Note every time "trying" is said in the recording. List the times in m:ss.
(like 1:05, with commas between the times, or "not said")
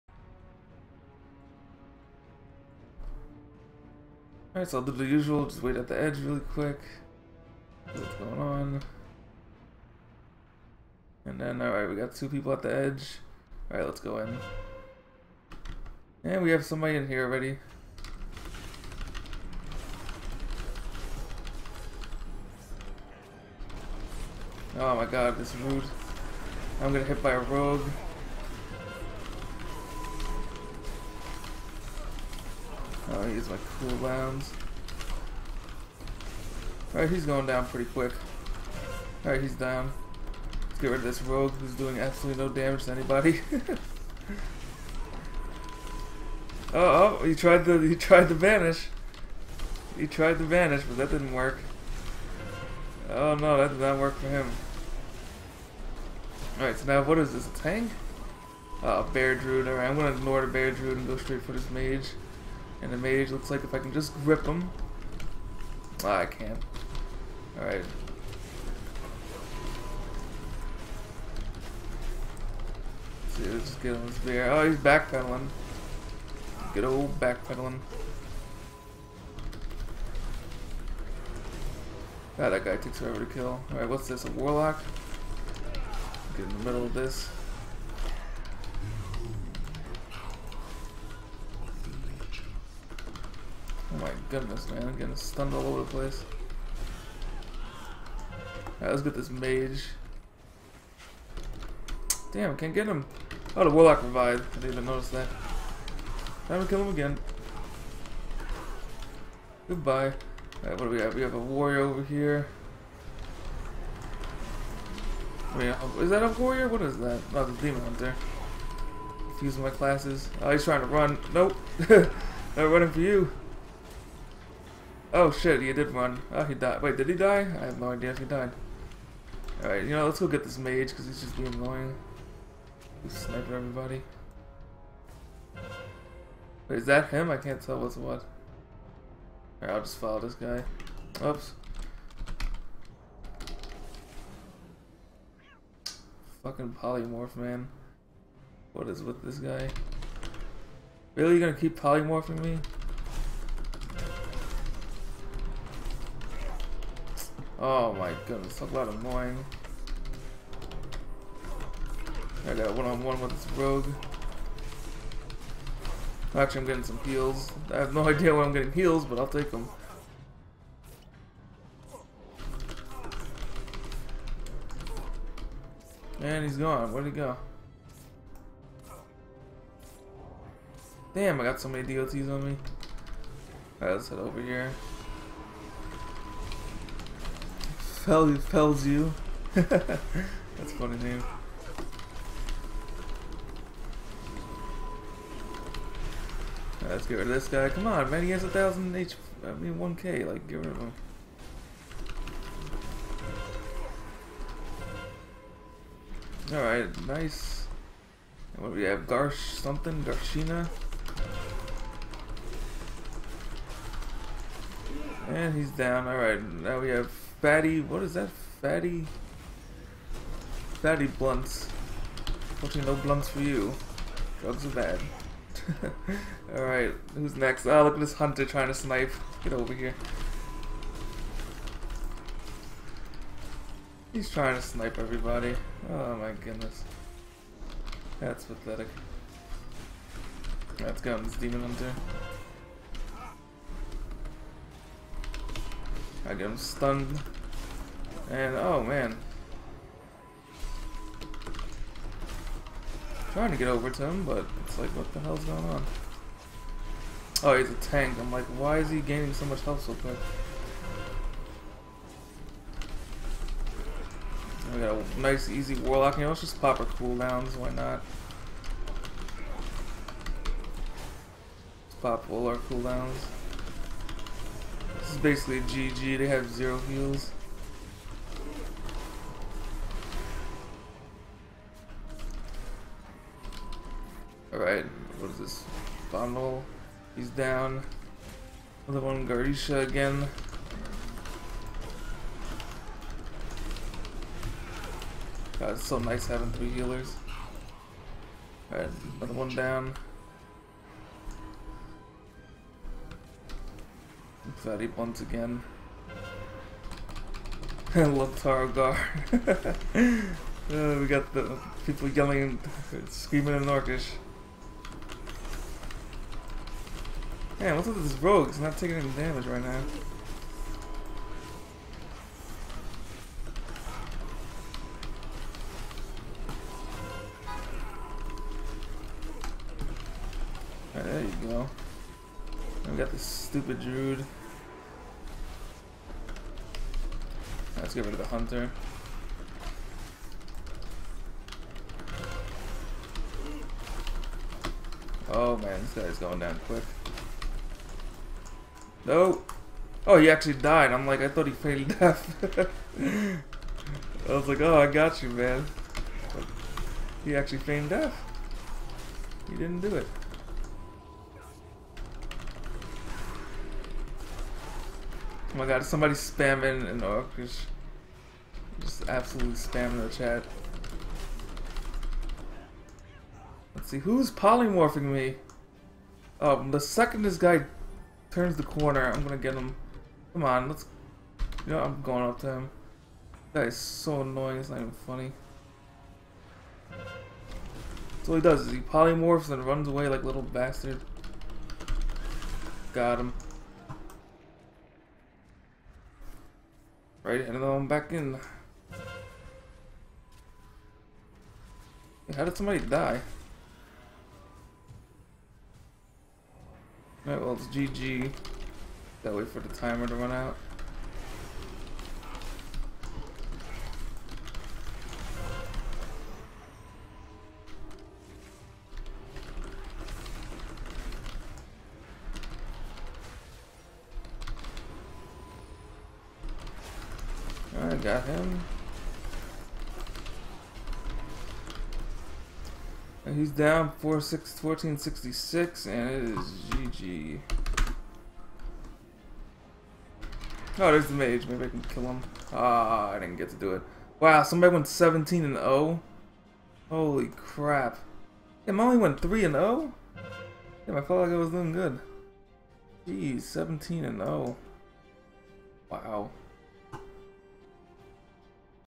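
2:00, 3:48, 3:54, 4:13.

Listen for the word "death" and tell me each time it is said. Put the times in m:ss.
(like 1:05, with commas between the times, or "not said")
5:51, 5:57.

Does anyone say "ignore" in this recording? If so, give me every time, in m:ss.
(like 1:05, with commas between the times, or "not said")
1:00.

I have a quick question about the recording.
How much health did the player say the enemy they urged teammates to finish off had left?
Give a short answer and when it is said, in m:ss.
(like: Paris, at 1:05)
1K, at 3:19.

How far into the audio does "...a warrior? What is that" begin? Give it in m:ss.
1:56.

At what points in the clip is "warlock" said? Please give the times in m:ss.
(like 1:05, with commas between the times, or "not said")
1:24, 1:43, 4:25.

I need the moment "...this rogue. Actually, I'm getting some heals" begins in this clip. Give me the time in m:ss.
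2:43.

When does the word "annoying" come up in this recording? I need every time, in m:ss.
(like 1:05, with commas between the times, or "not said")
2:11, 2:38, 6:24.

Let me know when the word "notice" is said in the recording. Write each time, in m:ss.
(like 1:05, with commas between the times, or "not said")
1:44.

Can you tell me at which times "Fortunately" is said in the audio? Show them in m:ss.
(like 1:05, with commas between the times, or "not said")
3:42.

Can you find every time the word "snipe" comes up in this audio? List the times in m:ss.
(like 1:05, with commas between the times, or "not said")
3:48, 3:54.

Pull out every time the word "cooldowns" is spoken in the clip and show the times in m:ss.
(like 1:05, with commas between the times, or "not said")
0:33, 4:26, 4:32.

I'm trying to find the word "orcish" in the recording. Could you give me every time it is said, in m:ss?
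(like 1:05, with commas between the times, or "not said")
5:13, 6:07.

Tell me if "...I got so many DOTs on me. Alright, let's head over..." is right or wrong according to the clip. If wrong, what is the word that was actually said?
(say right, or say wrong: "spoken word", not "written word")
right.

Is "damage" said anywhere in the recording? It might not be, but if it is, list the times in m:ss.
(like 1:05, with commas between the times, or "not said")
0:42, 5:19.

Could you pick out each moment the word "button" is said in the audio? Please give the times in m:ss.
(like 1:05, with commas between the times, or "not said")
not said.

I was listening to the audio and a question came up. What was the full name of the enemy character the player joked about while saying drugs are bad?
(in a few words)
Fatty Blunts.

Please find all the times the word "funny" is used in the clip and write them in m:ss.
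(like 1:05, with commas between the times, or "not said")
3:10, 6:24.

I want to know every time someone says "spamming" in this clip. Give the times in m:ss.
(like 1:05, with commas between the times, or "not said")
6:06.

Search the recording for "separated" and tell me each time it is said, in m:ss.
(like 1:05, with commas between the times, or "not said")
not said.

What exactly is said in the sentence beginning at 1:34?
I'm getting stunned all over the place.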